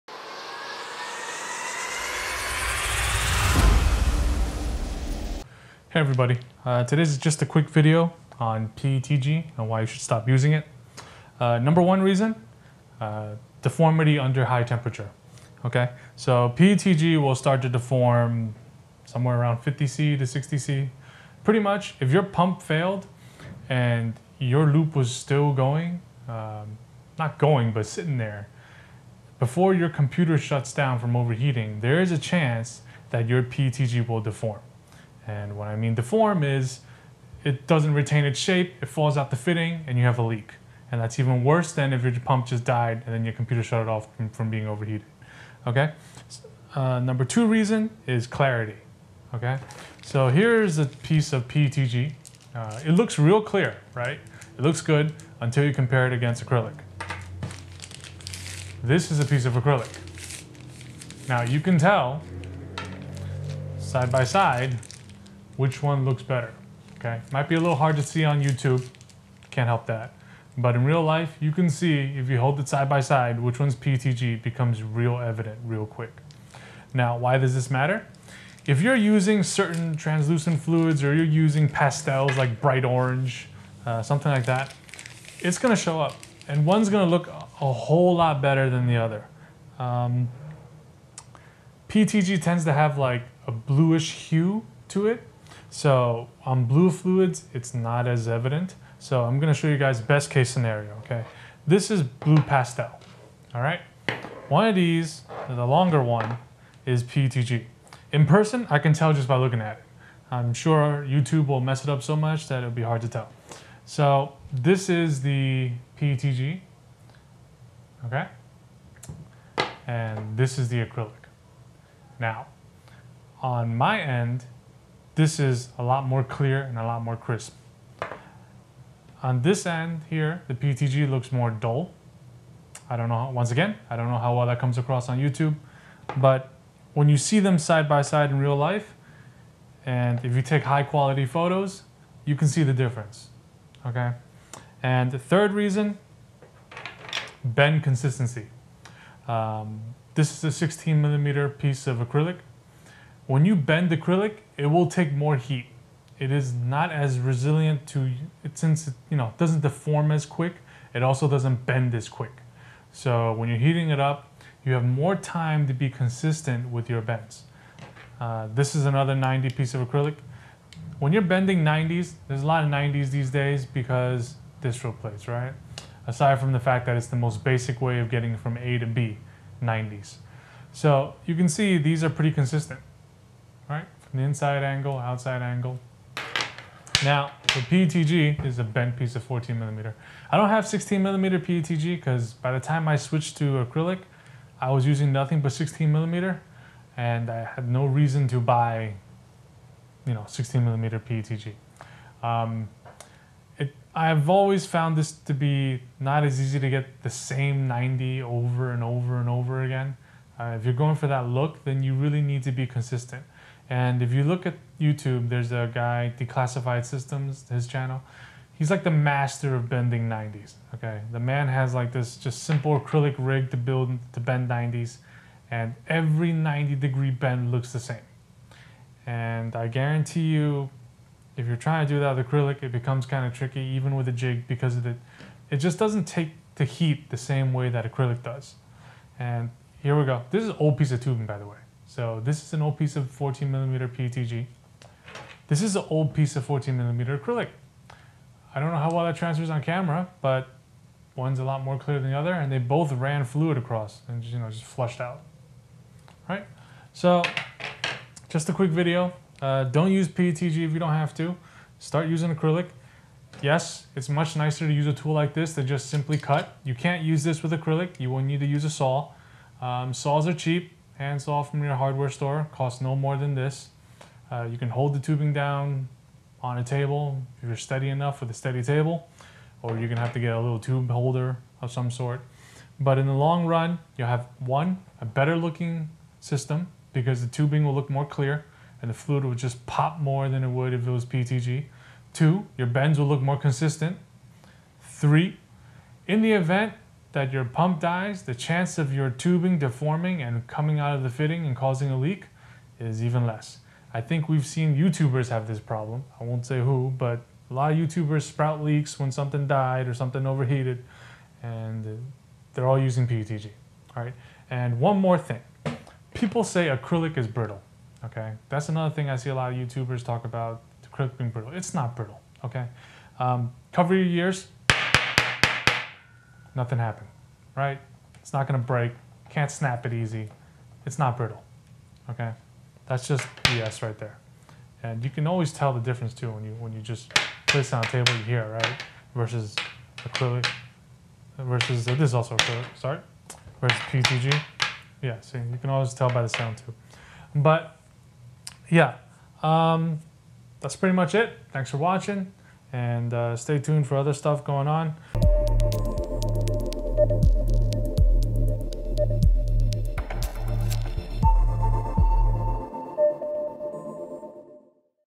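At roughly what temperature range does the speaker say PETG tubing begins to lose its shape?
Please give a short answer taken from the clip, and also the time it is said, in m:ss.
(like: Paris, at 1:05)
50 C to 60 C, at 0:19.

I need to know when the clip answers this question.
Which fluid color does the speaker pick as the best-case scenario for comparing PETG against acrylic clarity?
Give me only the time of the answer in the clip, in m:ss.
1:42.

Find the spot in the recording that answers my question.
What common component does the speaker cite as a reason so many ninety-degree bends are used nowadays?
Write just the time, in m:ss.
2:54.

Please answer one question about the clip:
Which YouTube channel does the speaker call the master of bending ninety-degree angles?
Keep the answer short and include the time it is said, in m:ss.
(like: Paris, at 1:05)
Declassified Systems, at 3:36.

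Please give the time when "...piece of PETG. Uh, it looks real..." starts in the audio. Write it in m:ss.
0:50.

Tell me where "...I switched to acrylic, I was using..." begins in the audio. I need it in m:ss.
3:12.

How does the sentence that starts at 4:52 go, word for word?
Two, your bends will look more consistent.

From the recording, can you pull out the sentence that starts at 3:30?
Uh, if you're going for that look, then you really need to be consistent.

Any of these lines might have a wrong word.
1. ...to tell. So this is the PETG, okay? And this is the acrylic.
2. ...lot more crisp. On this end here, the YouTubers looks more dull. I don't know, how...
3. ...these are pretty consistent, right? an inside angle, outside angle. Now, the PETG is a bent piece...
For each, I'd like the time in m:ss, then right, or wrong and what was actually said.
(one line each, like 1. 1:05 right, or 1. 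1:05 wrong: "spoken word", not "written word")
1. 1:53 right
2. 2:06 wrong: "PTG", not "YouTubers"
3. 3:01 right.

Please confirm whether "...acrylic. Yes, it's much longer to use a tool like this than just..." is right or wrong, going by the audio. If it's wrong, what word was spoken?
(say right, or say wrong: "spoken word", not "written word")
wrong: "nicer", not "longer".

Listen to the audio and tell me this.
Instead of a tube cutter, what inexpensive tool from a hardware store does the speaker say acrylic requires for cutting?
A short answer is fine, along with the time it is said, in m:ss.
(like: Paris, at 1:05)
Hand saw, at 4:31.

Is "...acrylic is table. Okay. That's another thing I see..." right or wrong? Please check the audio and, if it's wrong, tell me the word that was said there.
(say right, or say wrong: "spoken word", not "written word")
wrong: "brittle", not "table".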